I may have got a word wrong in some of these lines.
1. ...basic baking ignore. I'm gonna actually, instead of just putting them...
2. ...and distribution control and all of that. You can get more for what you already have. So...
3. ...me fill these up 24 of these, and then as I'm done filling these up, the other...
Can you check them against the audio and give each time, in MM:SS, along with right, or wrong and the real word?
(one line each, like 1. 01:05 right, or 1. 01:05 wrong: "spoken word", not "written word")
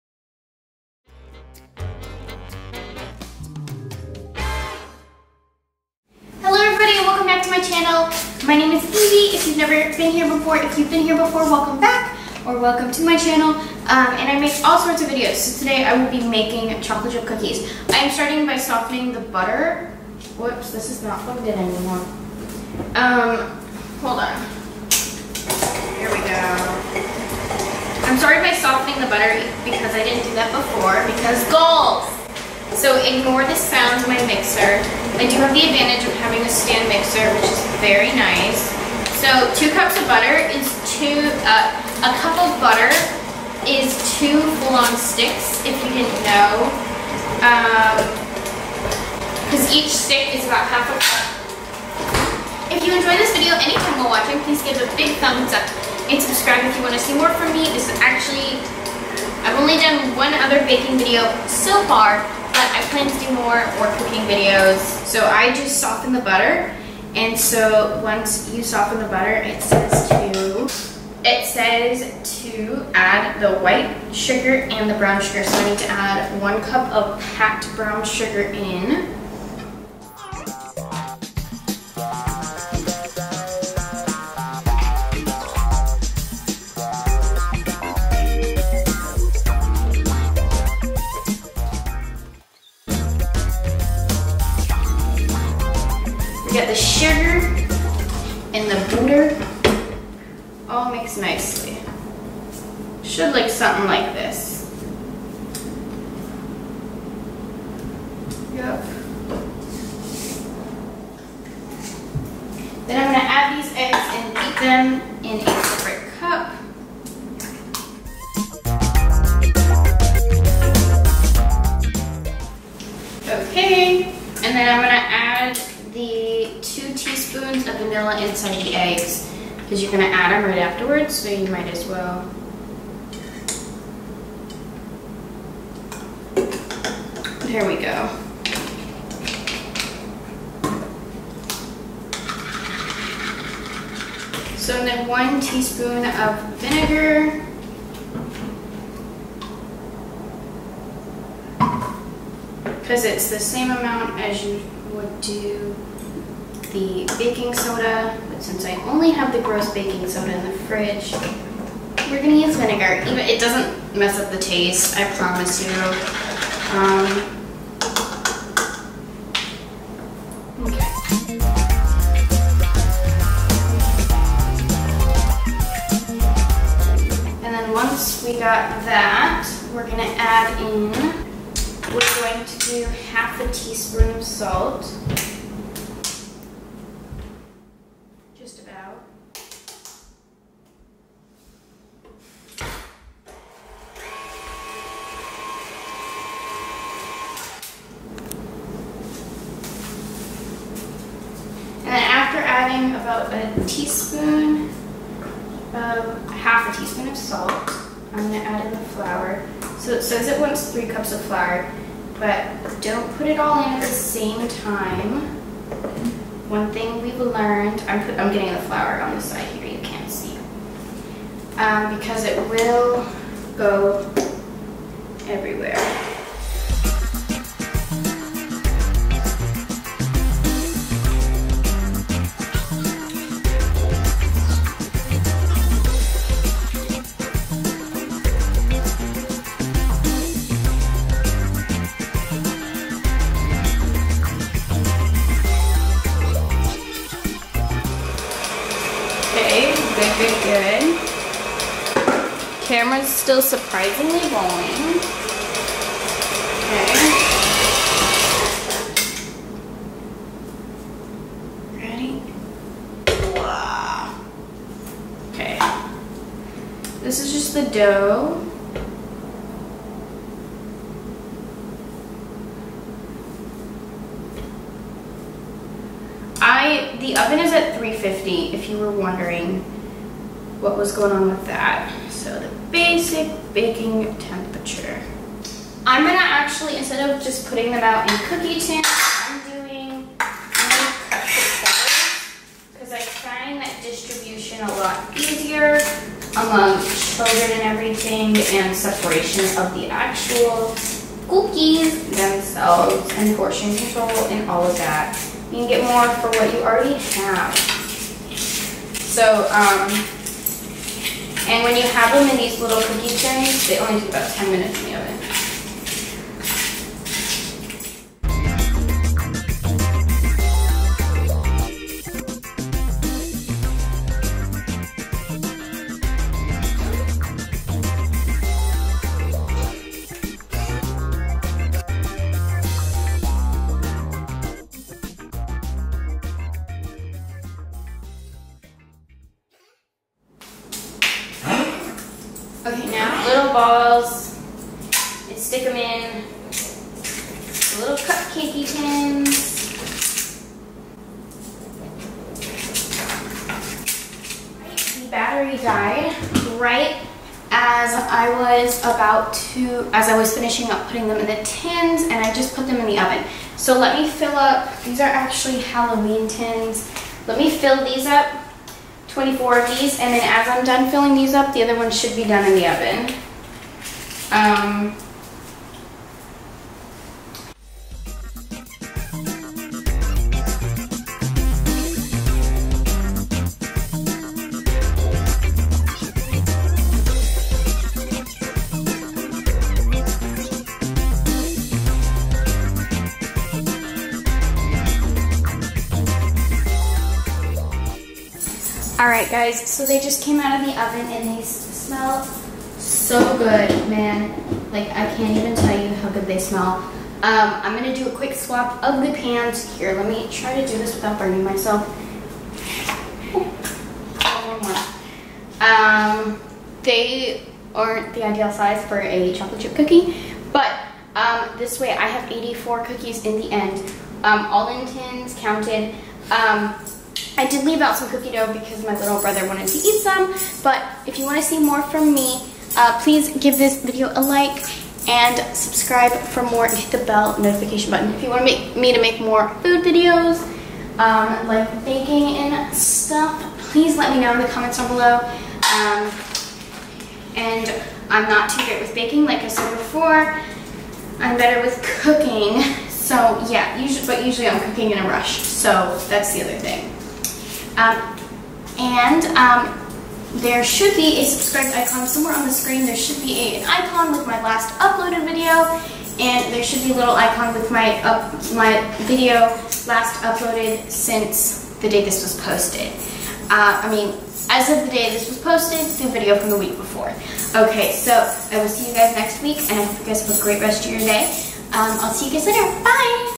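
1. 04:42 wrong: "temperature", not "ignore"
2. 05:03 wrong: "portion", not "distribution"
3. 06:07 right.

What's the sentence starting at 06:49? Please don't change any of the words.
Here, let me try to do this without burning myself.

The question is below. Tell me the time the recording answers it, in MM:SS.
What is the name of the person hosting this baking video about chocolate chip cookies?
00:08.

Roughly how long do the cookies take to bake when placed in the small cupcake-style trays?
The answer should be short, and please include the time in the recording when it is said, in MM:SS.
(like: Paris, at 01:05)
10 minutes, at 05:14.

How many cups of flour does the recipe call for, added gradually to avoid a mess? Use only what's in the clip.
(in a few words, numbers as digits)
3 cups.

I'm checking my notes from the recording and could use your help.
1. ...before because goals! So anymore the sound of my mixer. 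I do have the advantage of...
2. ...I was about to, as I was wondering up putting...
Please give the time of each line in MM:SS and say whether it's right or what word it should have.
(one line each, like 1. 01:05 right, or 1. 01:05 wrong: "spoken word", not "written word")
1. 00:30 wrong: "ignore", not "anymore"
2. 05:58 wrong: "finishing", not "wondering".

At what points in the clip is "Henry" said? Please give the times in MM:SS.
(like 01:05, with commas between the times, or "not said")
not said.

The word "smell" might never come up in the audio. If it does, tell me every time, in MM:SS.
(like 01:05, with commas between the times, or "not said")
06:41, 06:46.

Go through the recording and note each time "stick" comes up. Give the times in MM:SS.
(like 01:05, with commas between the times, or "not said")
00:44, 00:49, 05:45.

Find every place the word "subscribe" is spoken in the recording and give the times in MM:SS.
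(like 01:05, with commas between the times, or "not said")
00:56, 07:15, 07:41.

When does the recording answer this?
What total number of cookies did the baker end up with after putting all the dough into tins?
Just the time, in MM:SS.
07:02.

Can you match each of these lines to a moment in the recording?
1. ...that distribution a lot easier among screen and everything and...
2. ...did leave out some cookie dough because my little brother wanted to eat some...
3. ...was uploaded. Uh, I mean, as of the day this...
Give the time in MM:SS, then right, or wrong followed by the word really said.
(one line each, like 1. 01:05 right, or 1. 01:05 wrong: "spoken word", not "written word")
1. 04:53 wrong: "children", not "screen"
2. 07:07 right
3. 07:52 wrong: "posted", not "uploaded".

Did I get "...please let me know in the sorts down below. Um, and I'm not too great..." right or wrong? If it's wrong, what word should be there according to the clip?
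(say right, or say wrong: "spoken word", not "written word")
wrong: "comments", not "sorts".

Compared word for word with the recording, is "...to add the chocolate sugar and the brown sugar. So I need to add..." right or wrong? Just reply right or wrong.
wrong.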